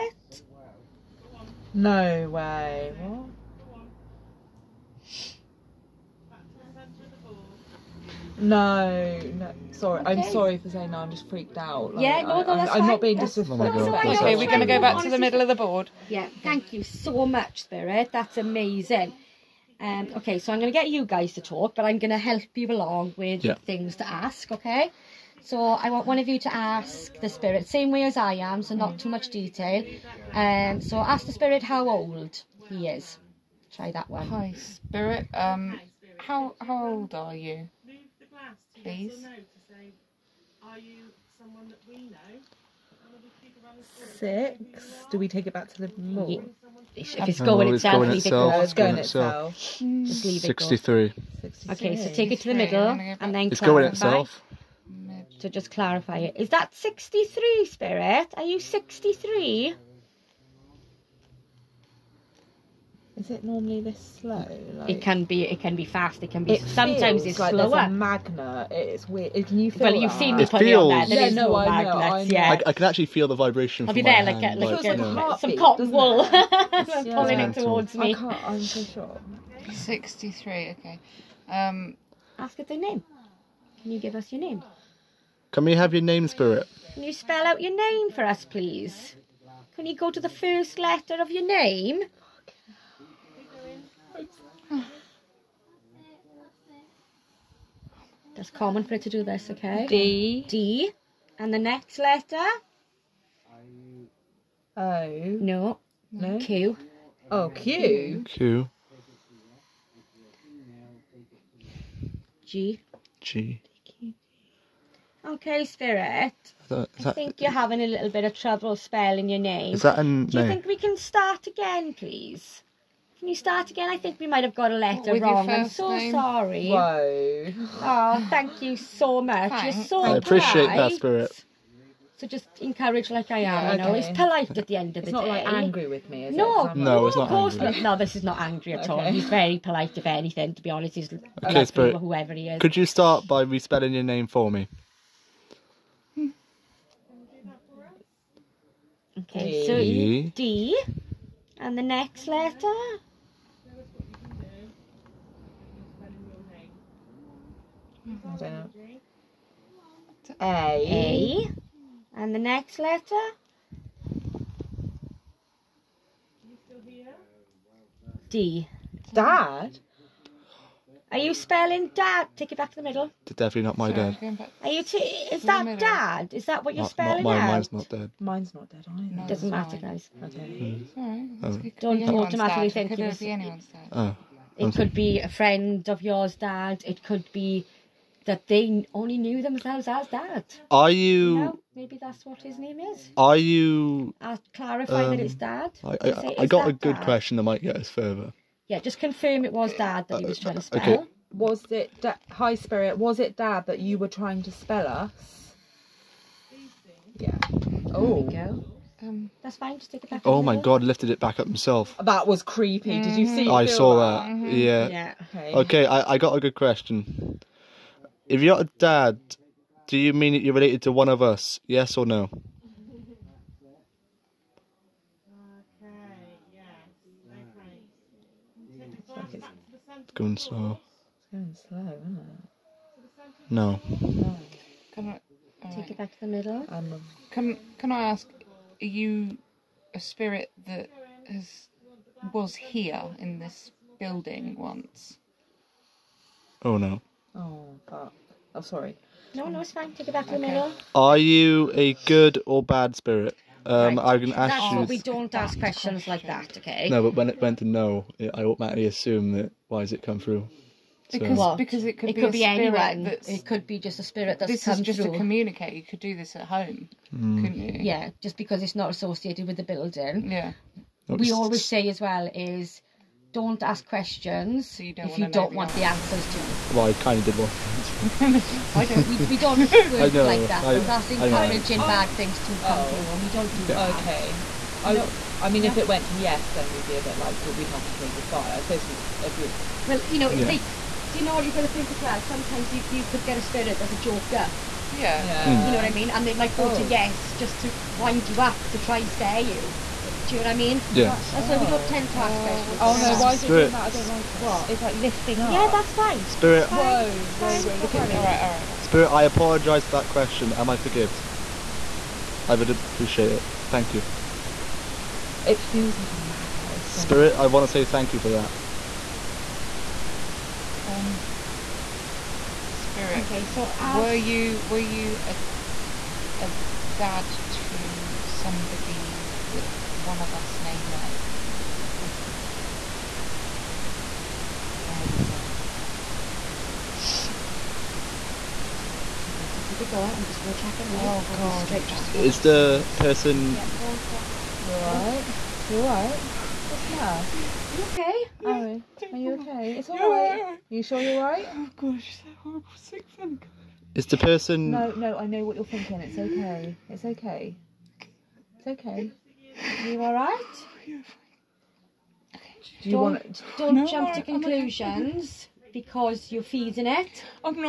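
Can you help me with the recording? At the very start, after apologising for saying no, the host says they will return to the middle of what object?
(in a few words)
the board.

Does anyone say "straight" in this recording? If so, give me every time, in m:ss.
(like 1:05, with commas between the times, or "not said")
5:41.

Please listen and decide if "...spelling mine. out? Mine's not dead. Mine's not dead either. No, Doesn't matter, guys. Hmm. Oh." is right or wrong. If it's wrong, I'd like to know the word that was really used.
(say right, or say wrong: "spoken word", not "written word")
right.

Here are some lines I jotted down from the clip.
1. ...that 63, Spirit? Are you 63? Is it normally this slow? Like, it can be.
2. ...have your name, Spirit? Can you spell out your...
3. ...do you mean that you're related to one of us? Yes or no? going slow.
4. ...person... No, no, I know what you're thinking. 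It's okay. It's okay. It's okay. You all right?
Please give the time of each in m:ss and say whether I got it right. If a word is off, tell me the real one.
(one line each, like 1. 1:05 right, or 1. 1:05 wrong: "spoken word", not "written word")
1. 0:56 right
2. 1:25 right
3. 3:39 right
4. 5:54 right.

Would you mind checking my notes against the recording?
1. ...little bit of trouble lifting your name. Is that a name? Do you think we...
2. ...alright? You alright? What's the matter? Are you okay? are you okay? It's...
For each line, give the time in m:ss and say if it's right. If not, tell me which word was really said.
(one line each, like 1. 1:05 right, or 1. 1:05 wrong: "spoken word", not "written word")
1. 1:57 wrong: "spelling", not "lifting"
2. 5:44 right.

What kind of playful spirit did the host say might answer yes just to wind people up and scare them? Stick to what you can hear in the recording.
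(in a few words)
a joker.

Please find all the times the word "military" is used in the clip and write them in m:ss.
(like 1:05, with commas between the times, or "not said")
not said.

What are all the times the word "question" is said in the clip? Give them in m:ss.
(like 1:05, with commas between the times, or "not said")
3:17, 3:36, 4:15, 4:33, 5:02, 5:10, 5:32.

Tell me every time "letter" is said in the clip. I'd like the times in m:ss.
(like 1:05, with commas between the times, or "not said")
1:30, 1:41, 2:04, 2:32, 2:42.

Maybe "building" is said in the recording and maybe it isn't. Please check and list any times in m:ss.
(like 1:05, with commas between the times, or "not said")
4:03, 4:29.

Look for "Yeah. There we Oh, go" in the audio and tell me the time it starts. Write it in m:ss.
3:27.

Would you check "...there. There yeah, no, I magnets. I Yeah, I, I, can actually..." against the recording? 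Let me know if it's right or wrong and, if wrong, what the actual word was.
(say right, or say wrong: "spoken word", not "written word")
right.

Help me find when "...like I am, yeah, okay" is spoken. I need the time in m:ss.
2:13.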